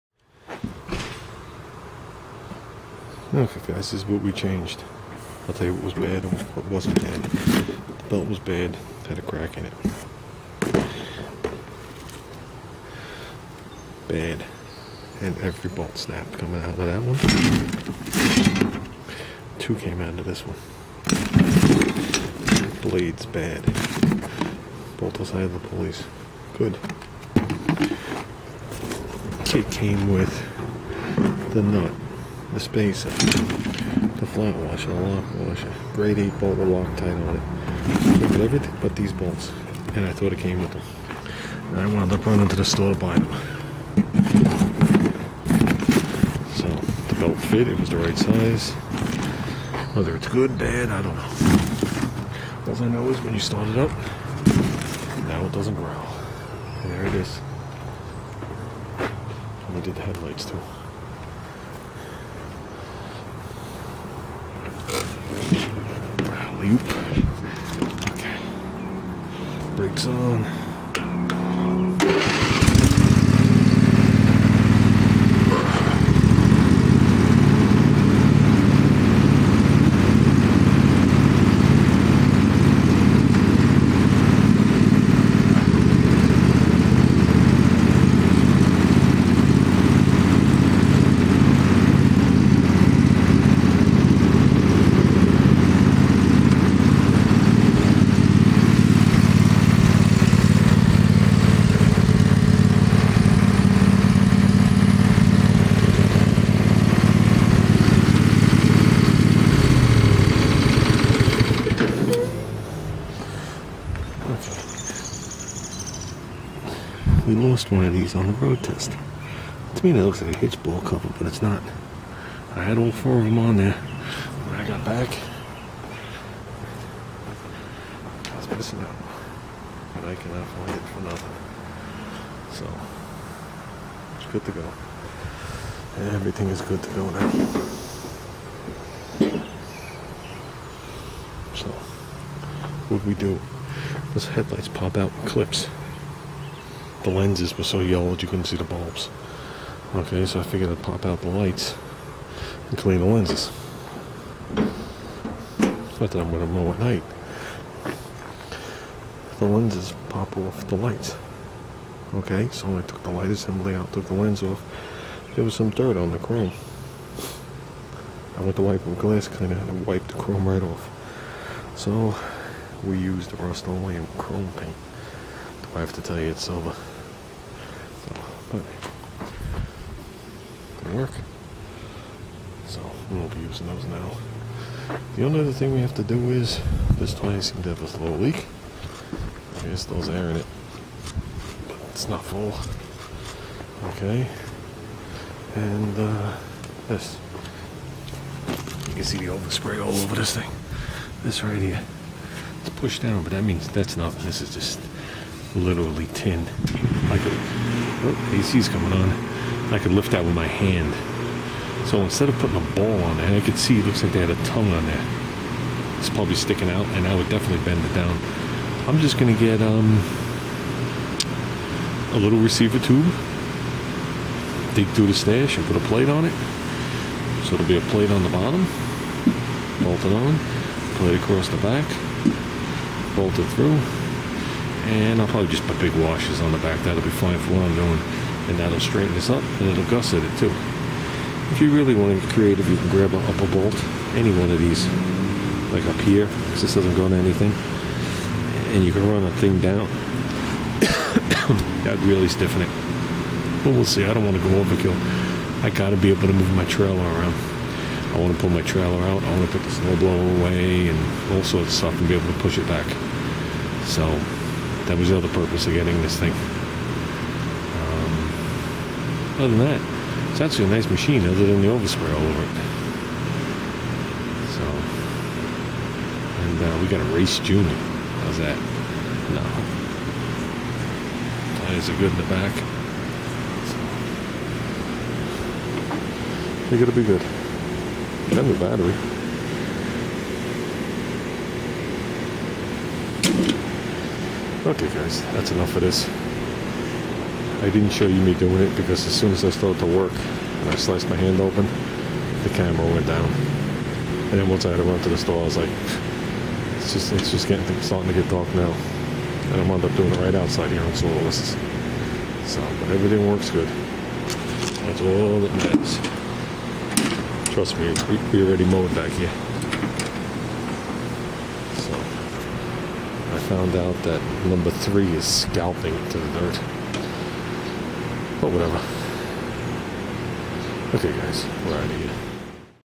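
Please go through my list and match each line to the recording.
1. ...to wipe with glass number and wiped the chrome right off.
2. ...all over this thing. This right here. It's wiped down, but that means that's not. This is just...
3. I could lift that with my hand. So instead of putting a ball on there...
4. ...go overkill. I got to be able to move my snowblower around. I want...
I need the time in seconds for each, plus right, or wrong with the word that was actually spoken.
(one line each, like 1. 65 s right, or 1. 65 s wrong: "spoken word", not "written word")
1. 168 s wrong: "cleaner", not "number"
2. 199 s wrong: "pushed", not "wiped"
3. 209 s right
4. 254 s wrong: "trailer", not "snowblower".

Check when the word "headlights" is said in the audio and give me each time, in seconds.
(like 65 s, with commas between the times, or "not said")
60 s, 144 s.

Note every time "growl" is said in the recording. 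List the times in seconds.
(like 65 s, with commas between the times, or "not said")
55 s.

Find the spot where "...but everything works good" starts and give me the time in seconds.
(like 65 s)
312 s.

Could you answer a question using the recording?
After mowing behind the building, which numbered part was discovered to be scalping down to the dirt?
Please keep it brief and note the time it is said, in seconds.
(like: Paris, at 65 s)
number 3, at 324 s.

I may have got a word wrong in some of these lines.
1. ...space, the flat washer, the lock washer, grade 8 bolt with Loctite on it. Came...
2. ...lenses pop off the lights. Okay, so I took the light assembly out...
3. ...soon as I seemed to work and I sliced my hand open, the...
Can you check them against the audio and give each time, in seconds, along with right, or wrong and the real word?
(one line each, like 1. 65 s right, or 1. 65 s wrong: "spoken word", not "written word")
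1. 32 s right
2. 159 s right
3. 299 s wrong: "started", not "seemed".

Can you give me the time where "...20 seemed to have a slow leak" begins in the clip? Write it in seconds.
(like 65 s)
187 s.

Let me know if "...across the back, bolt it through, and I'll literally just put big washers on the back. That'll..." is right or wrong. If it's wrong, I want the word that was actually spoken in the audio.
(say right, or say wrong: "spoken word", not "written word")
wrong: "probably", not "literally".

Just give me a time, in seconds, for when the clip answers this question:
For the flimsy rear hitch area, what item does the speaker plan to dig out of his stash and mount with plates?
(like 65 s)
222 s.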